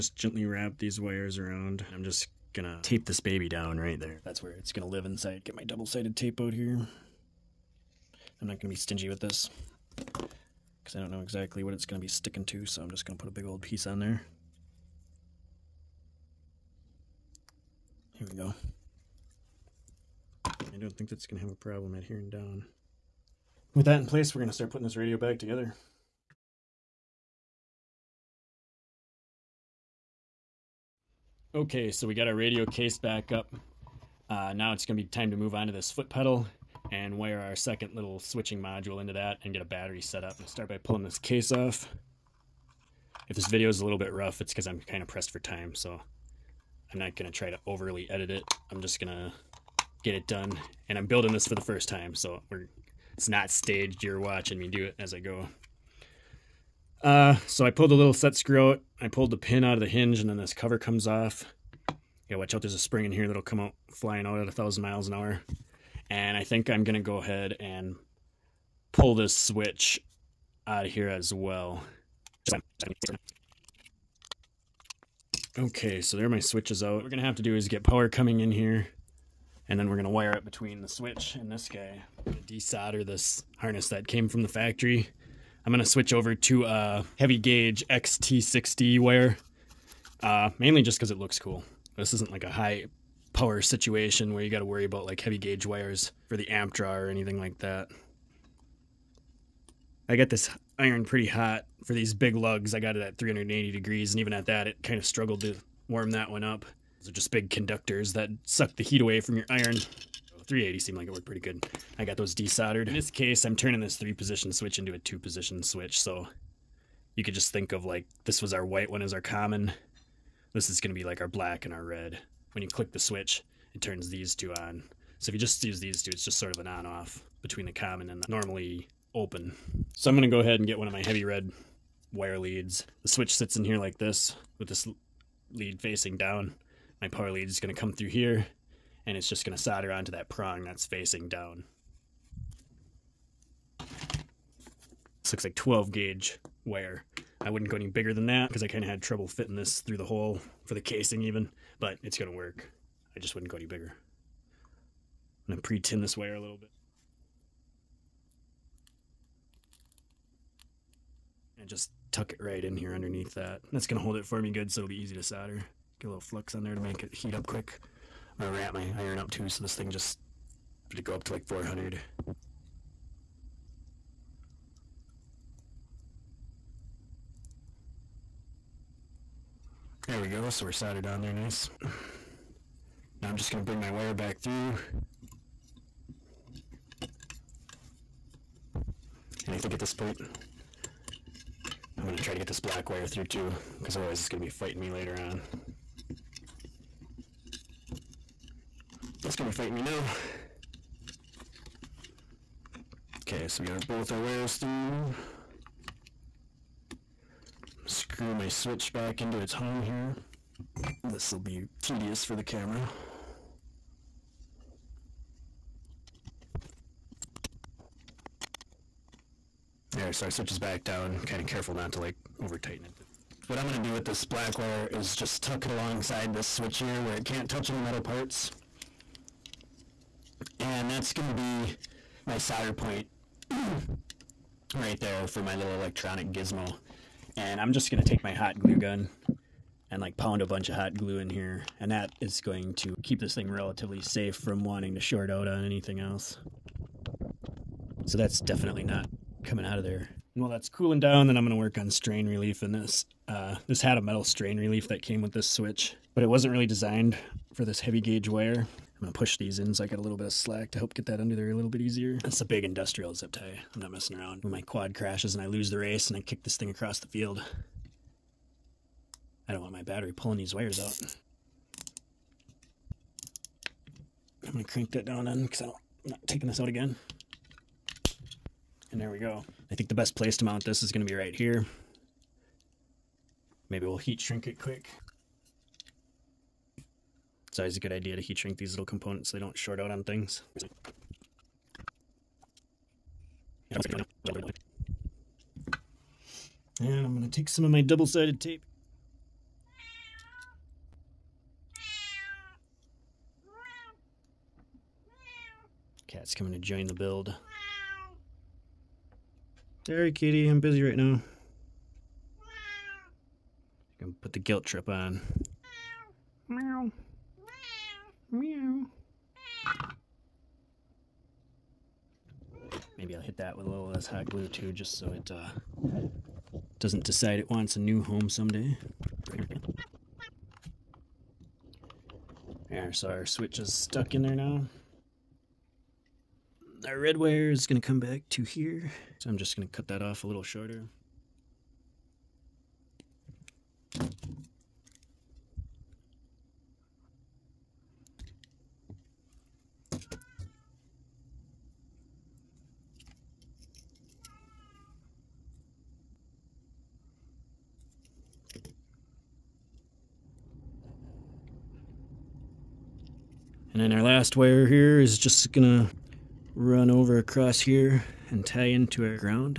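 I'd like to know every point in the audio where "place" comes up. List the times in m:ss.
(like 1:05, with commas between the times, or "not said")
0:24, 4:40.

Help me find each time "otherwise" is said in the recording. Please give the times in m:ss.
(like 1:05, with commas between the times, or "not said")
3:13.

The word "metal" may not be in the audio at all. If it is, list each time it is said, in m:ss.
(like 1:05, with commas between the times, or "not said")
3:47, 4:13.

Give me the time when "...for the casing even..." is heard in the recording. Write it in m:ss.
2:30.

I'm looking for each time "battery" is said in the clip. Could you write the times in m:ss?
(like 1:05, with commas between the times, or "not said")
0:39, 4:29.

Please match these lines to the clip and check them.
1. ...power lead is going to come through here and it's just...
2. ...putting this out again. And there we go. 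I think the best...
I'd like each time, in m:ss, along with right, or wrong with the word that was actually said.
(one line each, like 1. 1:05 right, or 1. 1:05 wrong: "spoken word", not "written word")
1. 2:17 right
2. 4:36 wrong: "taking", not "putting".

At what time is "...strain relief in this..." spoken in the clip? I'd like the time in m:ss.
4:11.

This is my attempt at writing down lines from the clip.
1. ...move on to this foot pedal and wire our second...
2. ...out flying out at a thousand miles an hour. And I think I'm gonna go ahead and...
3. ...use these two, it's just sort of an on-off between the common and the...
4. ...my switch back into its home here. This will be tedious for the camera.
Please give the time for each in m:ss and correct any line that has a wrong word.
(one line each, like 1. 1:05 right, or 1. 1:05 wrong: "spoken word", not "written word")
1. 0:35 right
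2. 1:03 right
3. 2:05 right
4. 3:28 right.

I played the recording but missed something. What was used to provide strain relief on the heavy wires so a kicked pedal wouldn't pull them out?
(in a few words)
industrial zip tie.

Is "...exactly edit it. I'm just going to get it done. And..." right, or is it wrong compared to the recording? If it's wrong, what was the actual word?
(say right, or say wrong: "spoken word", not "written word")
wrong: "overly", not "exactly".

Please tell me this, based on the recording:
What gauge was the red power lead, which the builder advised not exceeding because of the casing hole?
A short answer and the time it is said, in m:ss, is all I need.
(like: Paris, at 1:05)
12 gauge, at 2:25.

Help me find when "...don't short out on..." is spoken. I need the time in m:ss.
4:49.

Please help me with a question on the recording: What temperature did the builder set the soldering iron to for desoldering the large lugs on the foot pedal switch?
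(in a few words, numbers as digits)
380 degrees.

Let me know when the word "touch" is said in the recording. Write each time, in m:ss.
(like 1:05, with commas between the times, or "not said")
3:47.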